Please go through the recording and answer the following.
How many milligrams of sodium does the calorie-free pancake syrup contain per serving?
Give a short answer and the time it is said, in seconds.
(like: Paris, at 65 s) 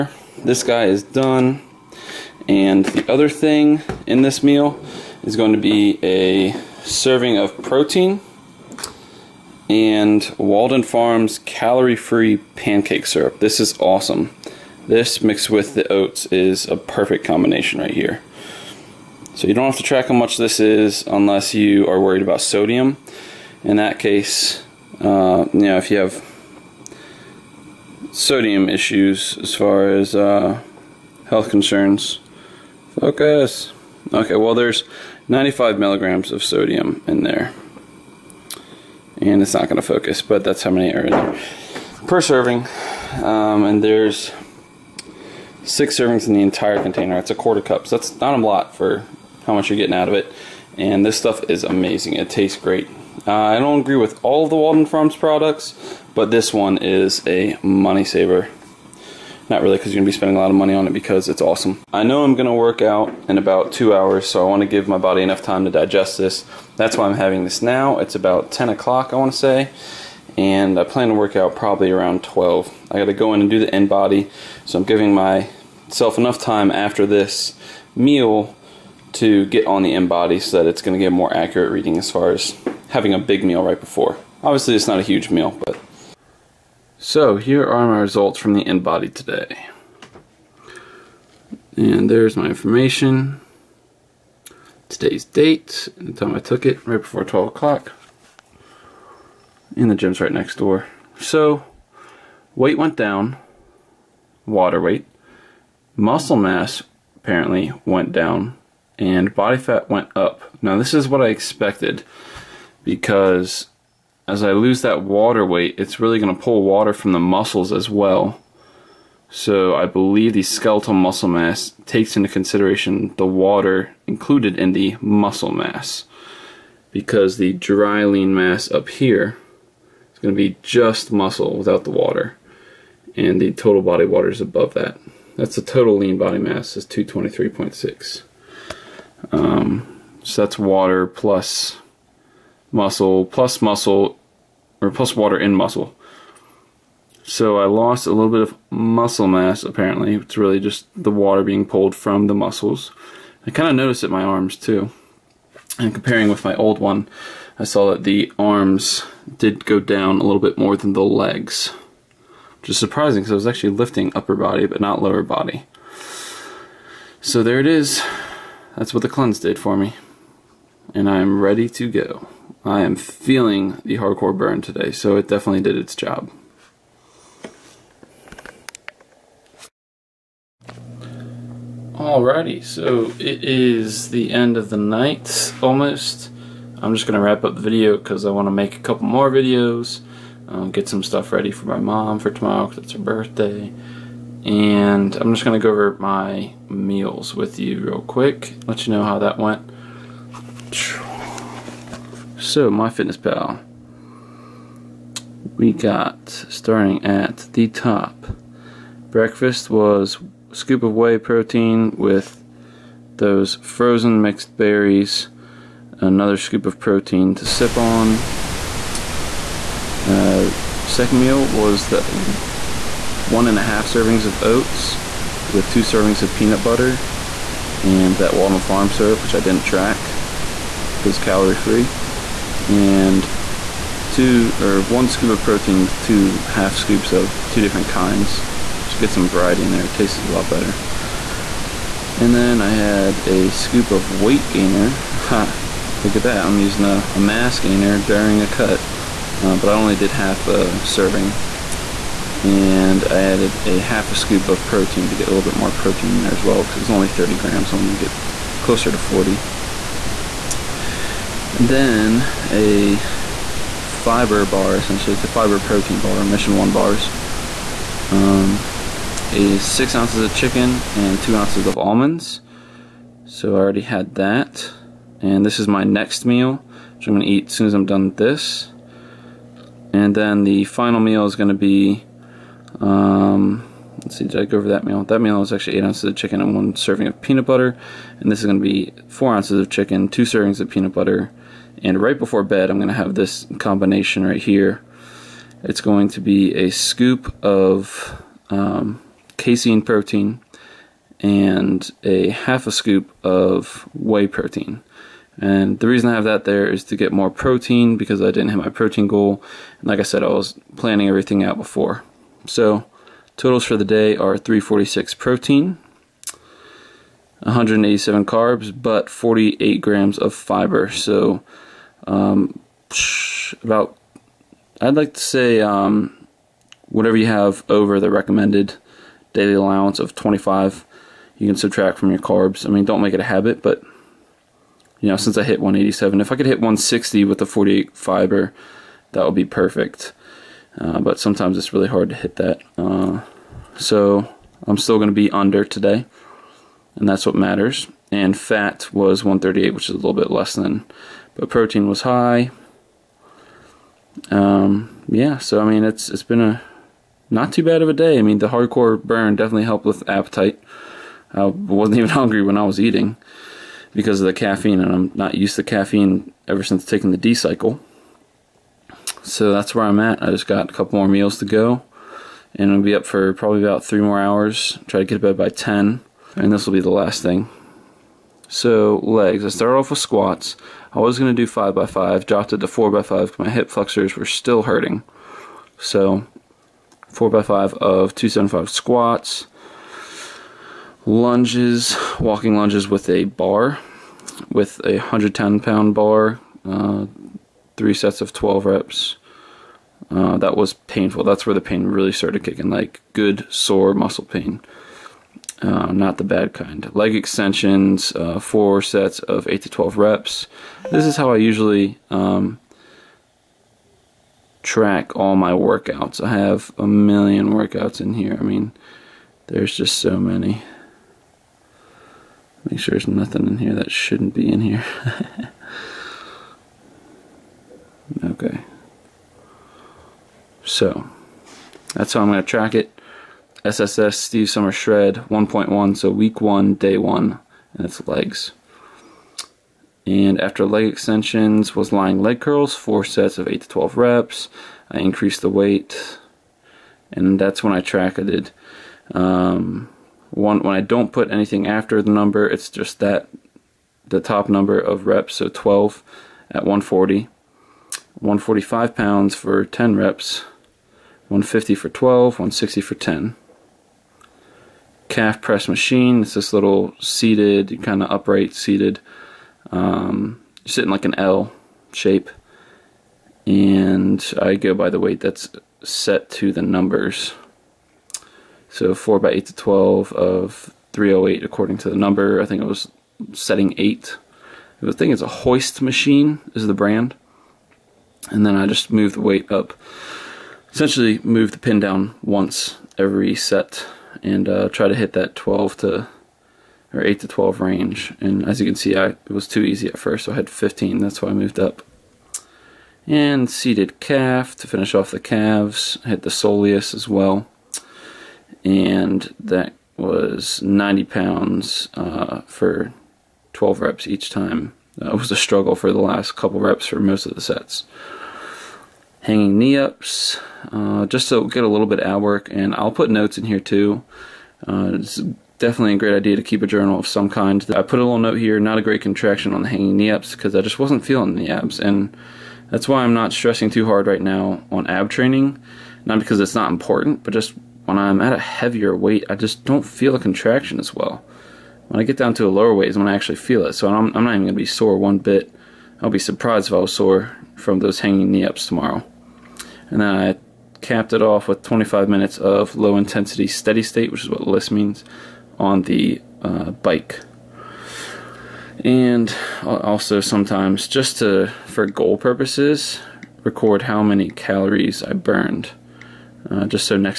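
95, at 35 s.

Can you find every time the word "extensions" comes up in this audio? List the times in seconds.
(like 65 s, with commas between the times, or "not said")
407 s, 440 s.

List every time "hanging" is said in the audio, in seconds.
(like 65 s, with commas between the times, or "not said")
519 s, 529 s, 547 s.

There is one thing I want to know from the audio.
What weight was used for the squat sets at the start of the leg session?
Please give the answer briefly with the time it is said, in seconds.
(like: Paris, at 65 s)
275, at 388 s.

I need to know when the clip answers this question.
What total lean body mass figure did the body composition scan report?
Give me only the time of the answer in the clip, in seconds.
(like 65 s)
136 s.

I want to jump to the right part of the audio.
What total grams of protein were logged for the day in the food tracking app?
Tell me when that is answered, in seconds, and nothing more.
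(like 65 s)
314 s.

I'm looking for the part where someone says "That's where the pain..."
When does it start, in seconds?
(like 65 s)
401 s.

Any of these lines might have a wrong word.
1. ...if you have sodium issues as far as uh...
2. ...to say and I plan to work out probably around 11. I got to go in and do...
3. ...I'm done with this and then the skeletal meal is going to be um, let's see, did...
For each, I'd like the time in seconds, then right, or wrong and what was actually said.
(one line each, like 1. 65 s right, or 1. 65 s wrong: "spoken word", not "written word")
1. 25 s right
2. 69 s wrong: "12", not "11"
3. 277 s wrong: "final", not "skeletal".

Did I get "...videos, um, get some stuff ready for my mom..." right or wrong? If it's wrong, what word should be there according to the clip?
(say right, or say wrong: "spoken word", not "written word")
right.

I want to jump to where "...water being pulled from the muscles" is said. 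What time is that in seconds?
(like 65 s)
151 s.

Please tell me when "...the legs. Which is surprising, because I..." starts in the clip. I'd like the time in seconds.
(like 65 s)
160 s.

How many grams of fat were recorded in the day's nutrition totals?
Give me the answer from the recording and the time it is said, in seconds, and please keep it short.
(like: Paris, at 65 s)
138, at 349 s.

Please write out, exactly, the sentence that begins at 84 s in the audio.
Obviously it's not a huge meal, but.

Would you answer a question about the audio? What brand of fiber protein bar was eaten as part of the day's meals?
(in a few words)
Mission 1.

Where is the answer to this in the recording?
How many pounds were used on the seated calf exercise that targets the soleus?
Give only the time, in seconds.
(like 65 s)
510 s.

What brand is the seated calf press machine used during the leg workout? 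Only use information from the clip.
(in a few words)
Hoist.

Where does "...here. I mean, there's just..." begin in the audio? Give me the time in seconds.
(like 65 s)
418 s.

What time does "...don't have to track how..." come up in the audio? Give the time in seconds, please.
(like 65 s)
19 s.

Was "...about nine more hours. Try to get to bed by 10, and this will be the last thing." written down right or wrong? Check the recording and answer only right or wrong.
wrong.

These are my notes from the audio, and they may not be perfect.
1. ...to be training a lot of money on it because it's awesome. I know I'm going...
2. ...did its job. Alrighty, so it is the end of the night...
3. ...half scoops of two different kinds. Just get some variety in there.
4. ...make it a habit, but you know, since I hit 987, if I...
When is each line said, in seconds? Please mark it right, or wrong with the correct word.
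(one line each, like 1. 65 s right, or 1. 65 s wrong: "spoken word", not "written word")
1. 60 s wrong: "spending", not "training"
2. 175 s right
3. 236 s right
4. 333 s wrong: "187", not "987".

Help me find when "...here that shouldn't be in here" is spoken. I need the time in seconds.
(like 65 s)
423 s.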